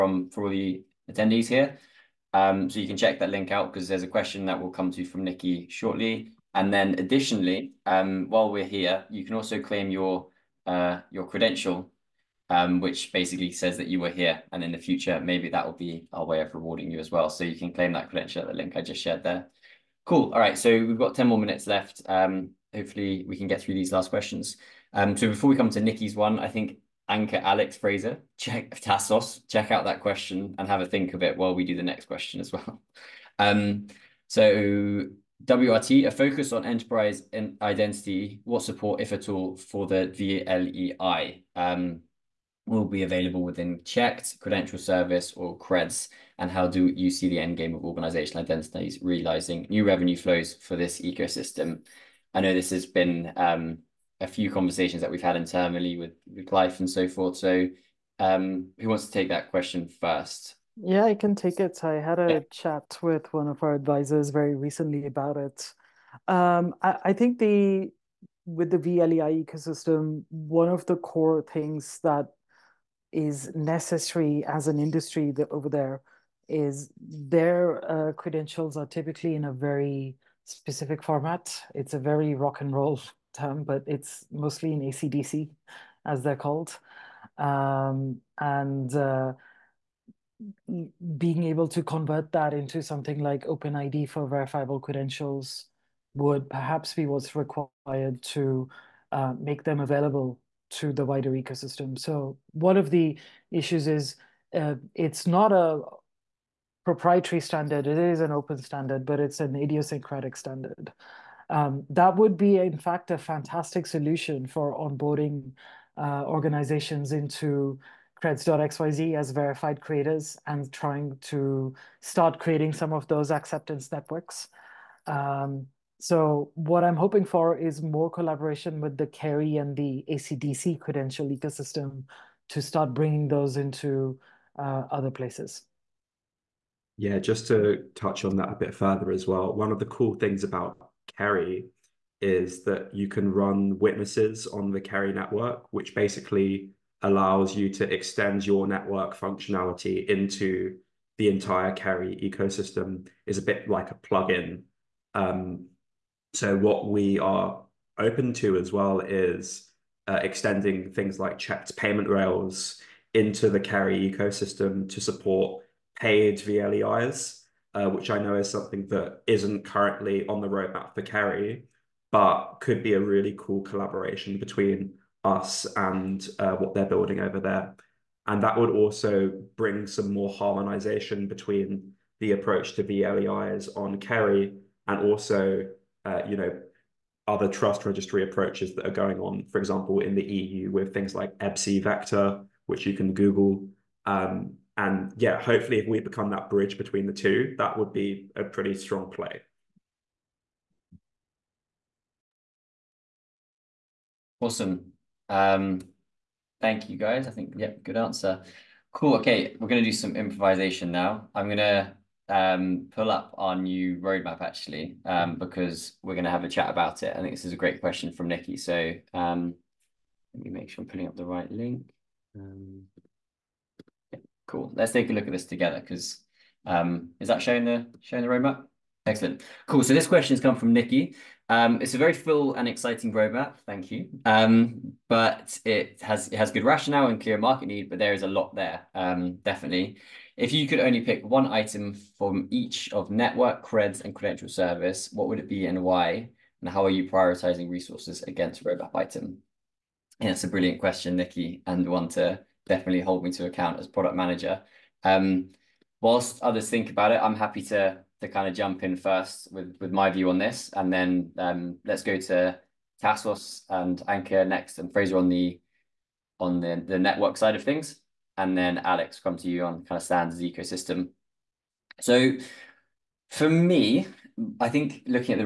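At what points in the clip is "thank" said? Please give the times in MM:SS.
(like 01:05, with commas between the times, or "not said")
03:26, 03:53.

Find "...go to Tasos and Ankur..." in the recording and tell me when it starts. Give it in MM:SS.
04:22.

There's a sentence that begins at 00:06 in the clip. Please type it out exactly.
And then additionally, while we're here, you can also claim your uh, credential um, which basically says that you were here.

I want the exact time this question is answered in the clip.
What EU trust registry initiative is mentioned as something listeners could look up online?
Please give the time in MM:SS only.
03:11.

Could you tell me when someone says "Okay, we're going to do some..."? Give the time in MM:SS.
03:29.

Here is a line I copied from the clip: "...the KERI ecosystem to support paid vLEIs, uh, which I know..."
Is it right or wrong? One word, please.
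right.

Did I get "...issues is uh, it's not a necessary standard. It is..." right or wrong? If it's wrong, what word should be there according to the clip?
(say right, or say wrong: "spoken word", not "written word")
wrong: "proprietary", not "necessary".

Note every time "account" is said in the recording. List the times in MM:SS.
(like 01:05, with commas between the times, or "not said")
04:13.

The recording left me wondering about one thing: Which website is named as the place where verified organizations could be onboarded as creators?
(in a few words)
creds.xyz.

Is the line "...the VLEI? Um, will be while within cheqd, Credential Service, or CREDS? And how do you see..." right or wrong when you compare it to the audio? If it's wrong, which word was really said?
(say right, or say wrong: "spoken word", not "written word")
wrong: "available", not "while".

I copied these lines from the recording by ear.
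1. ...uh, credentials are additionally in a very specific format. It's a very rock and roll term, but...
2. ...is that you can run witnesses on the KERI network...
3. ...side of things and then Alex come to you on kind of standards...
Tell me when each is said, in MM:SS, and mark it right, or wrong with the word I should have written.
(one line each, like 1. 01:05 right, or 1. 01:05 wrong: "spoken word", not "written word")
1. 01:17 wrong: "typically", not "additionally"
2. 02:22 right
3. 04:27 right.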